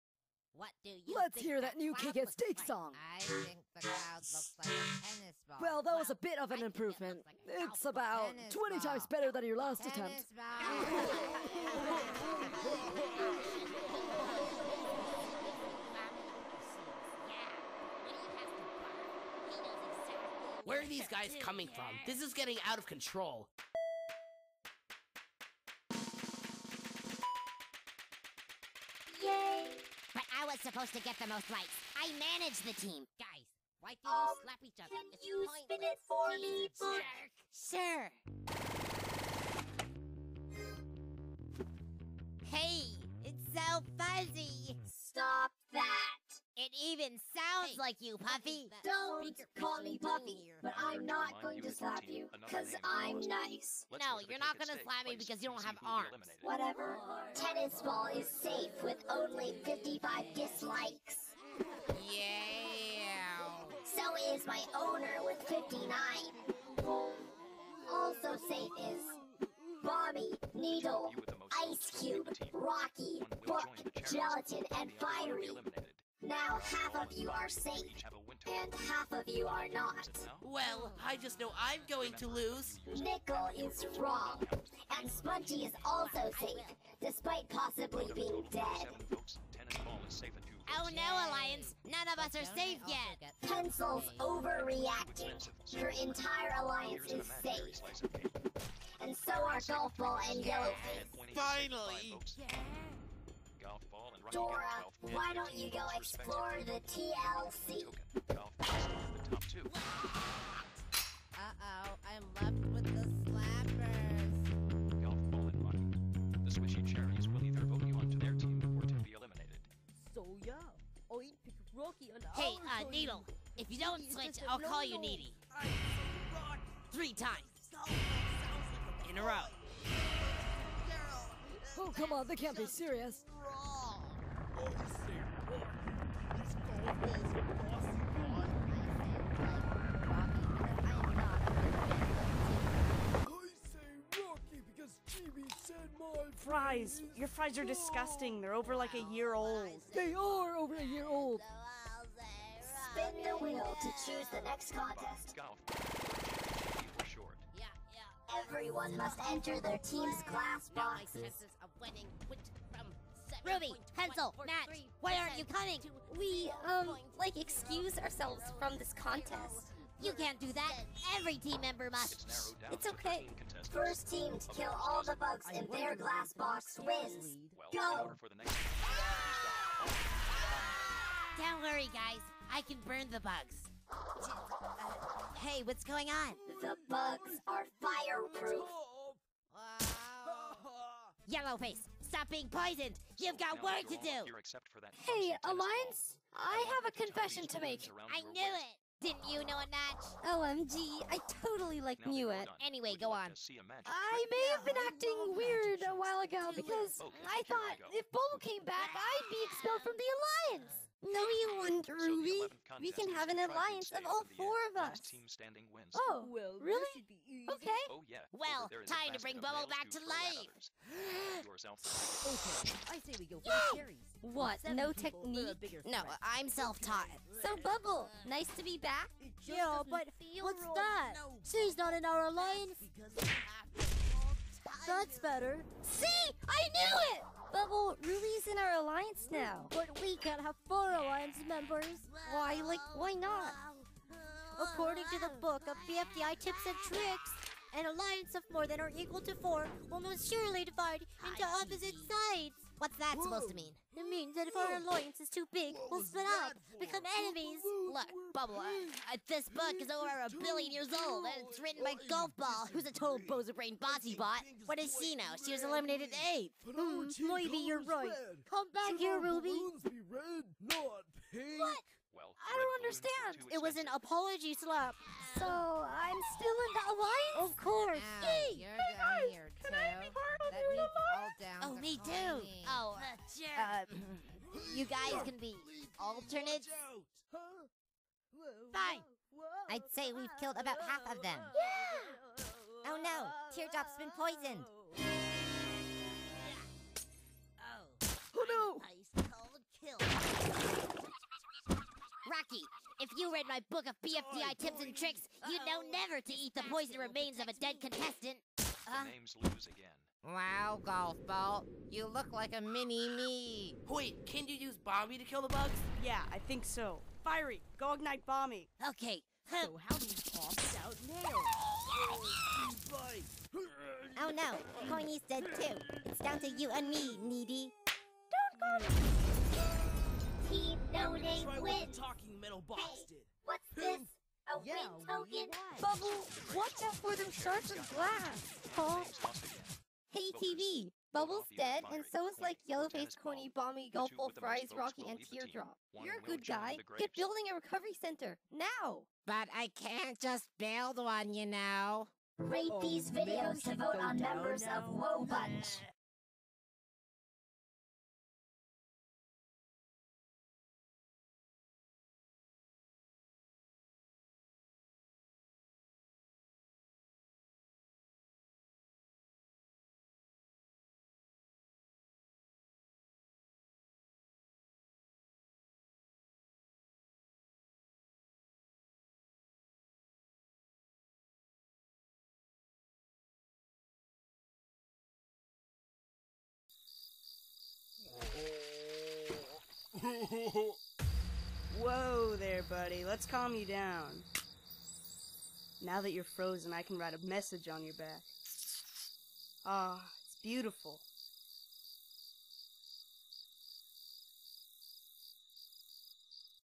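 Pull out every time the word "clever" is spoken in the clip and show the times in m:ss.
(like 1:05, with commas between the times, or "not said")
not said.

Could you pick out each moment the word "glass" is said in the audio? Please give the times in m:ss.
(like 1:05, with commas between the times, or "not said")
2:40, 2:55, 5:37.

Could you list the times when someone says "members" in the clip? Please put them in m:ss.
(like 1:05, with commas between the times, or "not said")
2:51, 4:01, 5:54.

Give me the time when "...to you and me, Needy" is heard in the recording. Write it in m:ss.
5:26.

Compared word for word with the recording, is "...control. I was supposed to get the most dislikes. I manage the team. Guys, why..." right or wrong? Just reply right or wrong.
wrong.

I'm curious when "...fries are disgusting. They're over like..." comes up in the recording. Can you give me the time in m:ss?
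2:27.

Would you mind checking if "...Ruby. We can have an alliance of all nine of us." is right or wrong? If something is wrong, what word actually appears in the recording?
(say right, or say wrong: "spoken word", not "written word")
wrong: "four", not "nine".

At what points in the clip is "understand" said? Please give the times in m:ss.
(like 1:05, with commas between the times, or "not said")
4:32.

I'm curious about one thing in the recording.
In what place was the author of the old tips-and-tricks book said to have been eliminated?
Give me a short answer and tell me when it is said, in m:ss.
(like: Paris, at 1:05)
Eighth, at 4:26.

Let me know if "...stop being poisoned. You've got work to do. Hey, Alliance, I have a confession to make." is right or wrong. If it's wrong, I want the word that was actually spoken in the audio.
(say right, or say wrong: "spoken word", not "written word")
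right.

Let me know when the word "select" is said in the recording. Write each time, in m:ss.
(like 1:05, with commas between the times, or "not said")
not said.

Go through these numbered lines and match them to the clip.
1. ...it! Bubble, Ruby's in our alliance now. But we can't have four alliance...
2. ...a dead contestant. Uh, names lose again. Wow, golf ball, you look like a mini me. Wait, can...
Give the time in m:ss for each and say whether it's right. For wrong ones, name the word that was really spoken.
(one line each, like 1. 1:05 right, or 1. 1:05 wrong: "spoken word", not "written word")
1. 3:57 right
2. 5:07 right.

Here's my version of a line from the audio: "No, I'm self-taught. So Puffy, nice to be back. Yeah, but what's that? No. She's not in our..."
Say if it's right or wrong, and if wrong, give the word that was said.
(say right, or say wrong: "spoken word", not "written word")
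wrong: "Bubble", not "Puffy".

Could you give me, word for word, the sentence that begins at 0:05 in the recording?
Well, that well, was a bit of an I improvement.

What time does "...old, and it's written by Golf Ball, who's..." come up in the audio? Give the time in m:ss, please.
4:21.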